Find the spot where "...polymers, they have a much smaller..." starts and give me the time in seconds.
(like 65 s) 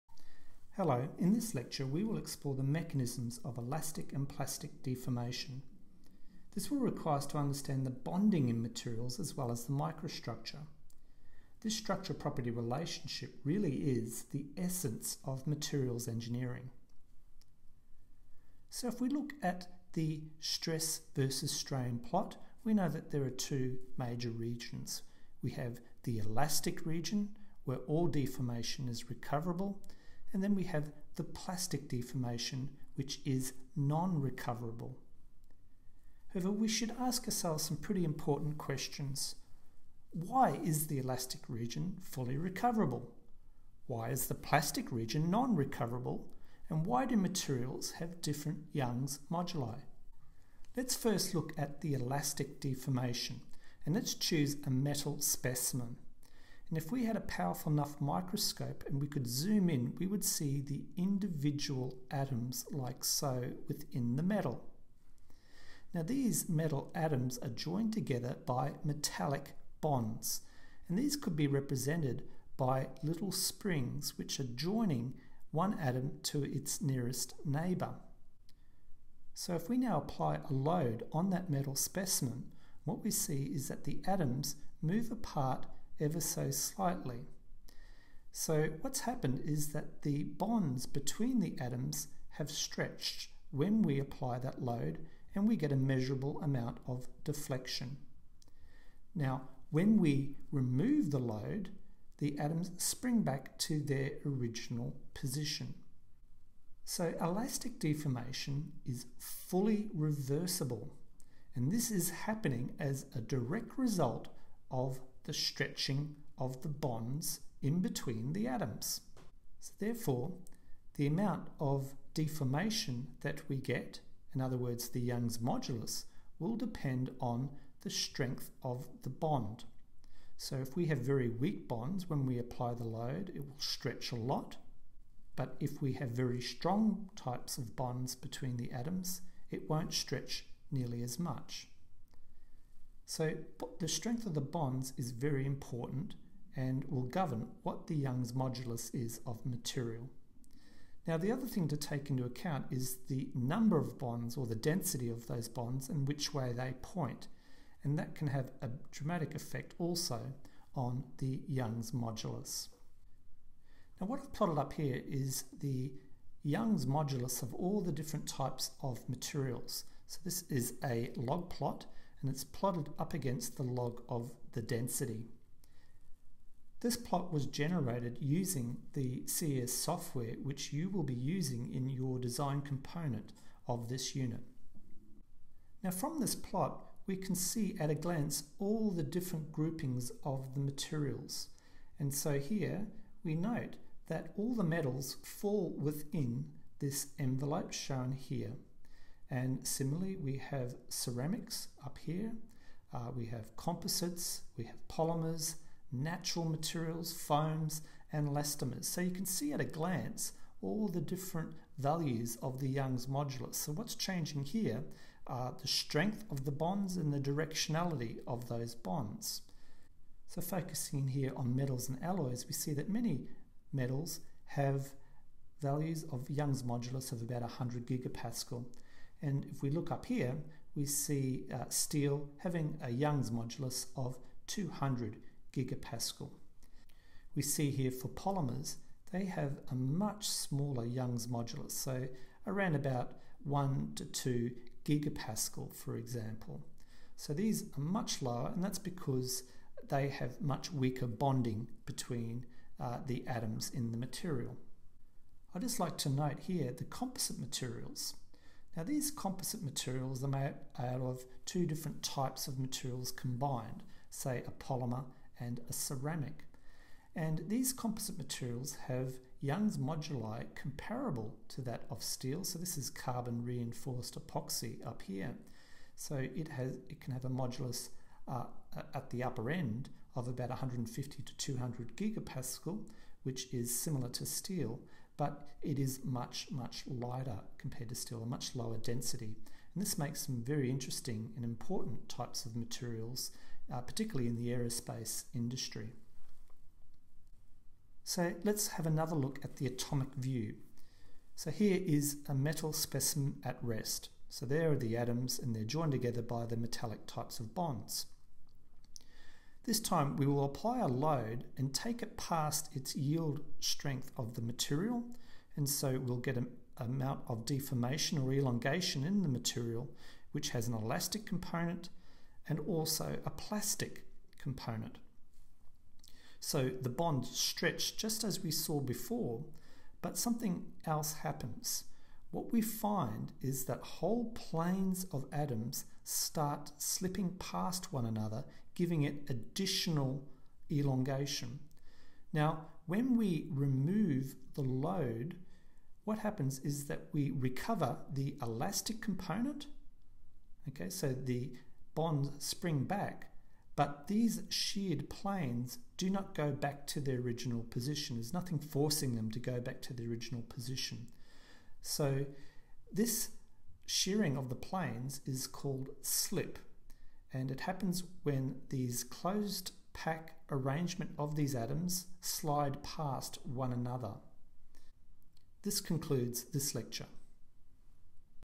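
238 s.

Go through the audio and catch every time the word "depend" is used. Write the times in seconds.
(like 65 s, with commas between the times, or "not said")
126 s.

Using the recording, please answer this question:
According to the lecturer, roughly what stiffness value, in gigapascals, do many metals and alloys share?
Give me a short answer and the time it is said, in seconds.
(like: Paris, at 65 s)
100 gigapascal, at 227 s.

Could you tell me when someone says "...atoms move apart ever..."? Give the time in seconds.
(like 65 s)
84 s.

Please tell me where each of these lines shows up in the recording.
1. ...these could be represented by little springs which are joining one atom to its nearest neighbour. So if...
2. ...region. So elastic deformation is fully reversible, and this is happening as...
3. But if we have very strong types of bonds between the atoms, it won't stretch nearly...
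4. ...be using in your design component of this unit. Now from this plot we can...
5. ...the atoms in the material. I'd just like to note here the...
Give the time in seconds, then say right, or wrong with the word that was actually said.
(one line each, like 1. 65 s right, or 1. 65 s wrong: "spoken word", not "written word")
1. 70 s right
2. 105 s wrong: "position", not "region"
3. 135 s right
4. 181 s right
5. 253 s right.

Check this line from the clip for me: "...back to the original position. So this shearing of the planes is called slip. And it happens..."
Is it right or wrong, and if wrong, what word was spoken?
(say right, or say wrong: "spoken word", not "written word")
right.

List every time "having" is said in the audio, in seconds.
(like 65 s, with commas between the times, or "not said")
232 s.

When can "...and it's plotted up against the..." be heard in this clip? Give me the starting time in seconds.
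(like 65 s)
172 s.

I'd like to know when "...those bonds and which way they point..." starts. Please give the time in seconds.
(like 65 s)
155 s.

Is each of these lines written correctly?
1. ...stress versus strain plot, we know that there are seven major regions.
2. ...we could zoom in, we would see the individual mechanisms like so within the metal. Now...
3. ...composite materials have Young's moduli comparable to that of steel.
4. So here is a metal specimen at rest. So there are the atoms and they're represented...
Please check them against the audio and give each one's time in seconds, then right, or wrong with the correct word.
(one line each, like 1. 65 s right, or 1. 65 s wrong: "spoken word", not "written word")
1. 20 s wrong: "two", not "seven"
2. 59 s wrong: "atoms", not "mechanisms"
3. 267 s right
4. 301 s wrong: "joined", not "represented".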